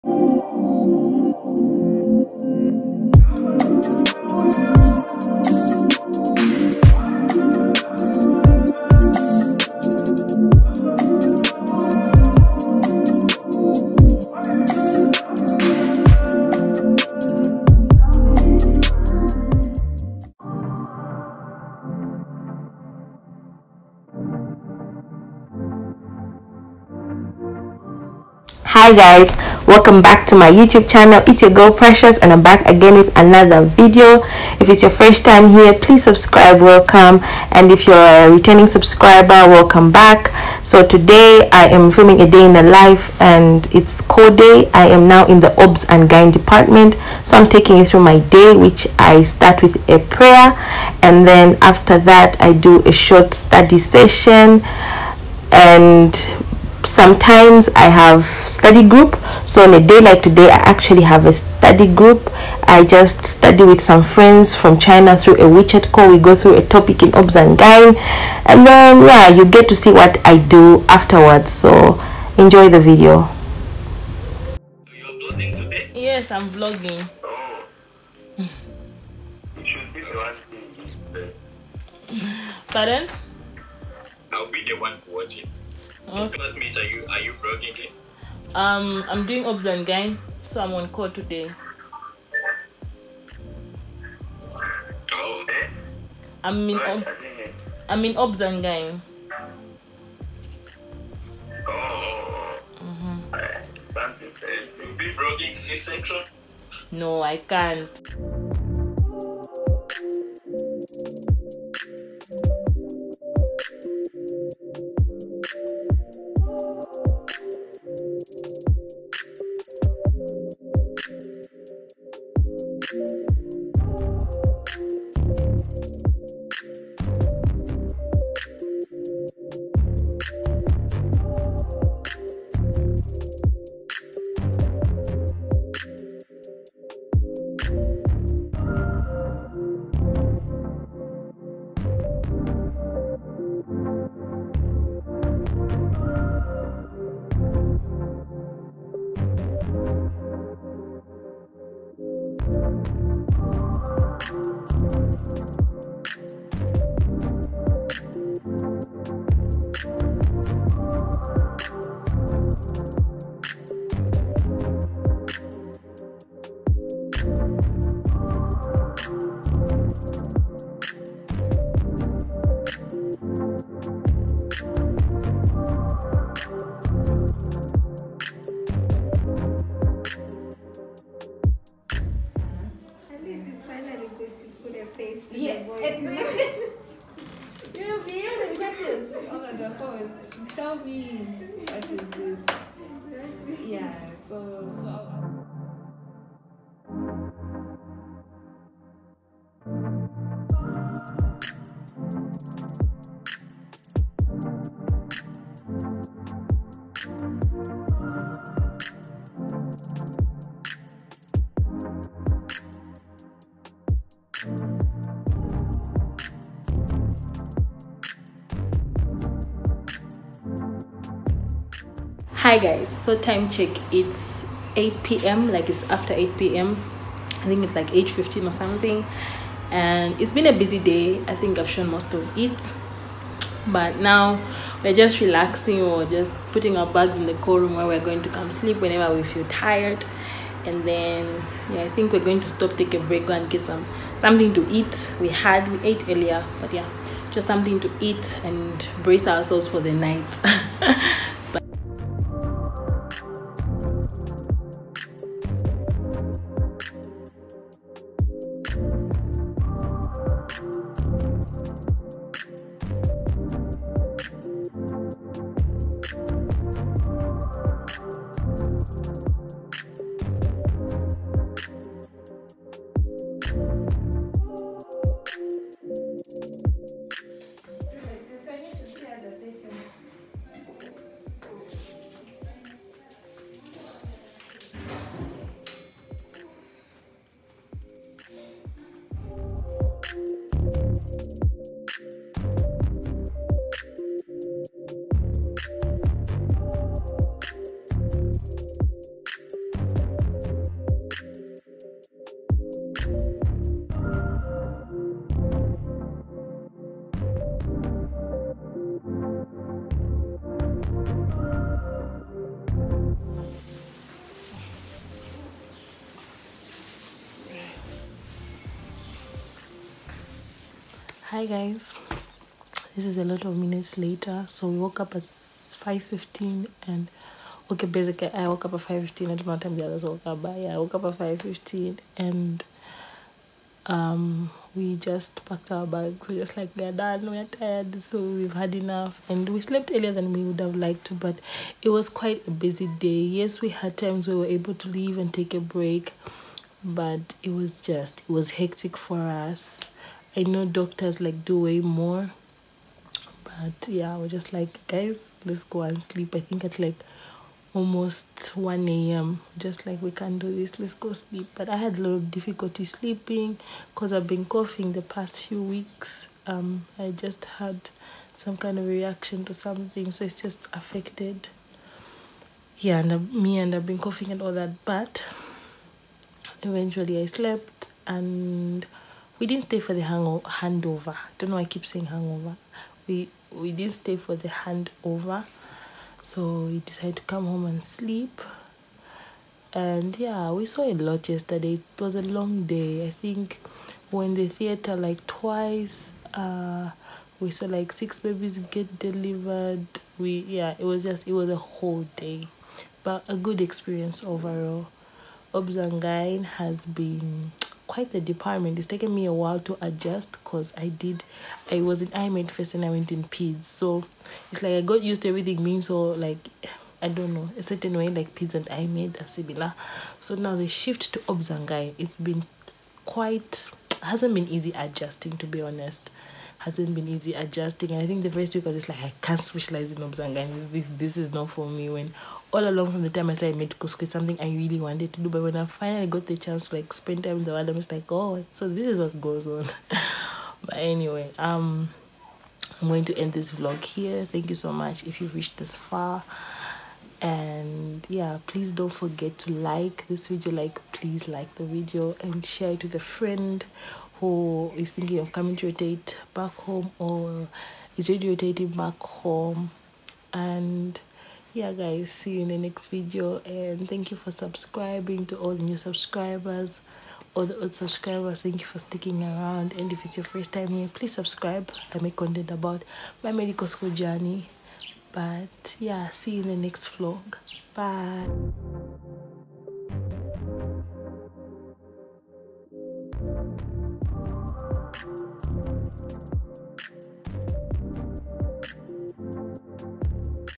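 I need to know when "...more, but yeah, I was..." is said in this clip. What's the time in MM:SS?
05:51.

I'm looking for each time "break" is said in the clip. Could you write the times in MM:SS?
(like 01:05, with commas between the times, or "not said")
04:03, 05:45.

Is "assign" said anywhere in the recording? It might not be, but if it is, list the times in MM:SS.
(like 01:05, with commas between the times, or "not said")
not said.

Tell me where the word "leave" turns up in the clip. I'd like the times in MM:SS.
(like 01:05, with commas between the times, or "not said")
05:44.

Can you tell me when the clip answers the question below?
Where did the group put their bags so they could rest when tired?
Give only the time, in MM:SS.
03:57.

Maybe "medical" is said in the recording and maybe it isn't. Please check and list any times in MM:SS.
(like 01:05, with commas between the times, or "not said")
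07:13, 07:53.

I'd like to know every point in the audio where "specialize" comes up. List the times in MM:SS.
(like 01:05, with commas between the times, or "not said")
07:09.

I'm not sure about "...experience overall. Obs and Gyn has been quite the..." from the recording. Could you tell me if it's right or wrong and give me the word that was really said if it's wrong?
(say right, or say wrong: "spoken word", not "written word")
right.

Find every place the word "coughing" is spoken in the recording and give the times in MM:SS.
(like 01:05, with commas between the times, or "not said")
06:04, 06:13.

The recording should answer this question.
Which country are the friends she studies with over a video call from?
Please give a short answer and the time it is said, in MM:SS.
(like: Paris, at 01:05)
China, at 01:04.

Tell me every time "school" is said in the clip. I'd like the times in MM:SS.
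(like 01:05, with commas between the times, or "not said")
07:13, 07:53.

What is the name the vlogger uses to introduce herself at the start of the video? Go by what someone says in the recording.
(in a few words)
Precious.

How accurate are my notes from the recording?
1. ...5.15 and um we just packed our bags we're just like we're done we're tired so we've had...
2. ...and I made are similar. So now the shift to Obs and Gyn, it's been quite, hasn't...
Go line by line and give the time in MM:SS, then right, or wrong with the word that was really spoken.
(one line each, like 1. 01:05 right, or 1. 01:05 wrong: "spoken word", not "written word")
1. 05:31 right
2. 06:58 right.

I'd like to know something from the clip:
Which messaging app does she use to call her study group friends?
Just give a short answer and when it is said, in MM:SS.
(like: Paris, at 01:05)
WeChat, at 01:05.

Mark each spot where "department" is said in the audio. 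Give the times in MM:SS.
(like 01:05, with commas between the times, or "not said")
00:46, 06:48.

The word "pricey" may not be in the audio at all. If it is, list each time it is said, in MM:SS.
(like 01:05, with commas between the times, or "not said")
not said.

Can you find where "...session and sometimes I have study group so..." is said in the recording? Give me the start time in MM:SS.
00:53.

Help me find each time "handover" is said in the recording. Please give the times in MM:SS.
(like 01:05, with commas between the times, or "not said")
06:20, 06:24.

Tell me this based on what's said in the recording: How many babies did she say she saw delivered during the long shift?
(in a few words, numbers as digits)
6.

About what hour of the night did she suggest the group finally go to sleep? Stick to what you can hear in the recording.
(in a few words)
1 a.m.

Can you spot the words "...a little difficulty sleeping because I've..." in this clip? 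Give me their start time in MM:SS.
06:01.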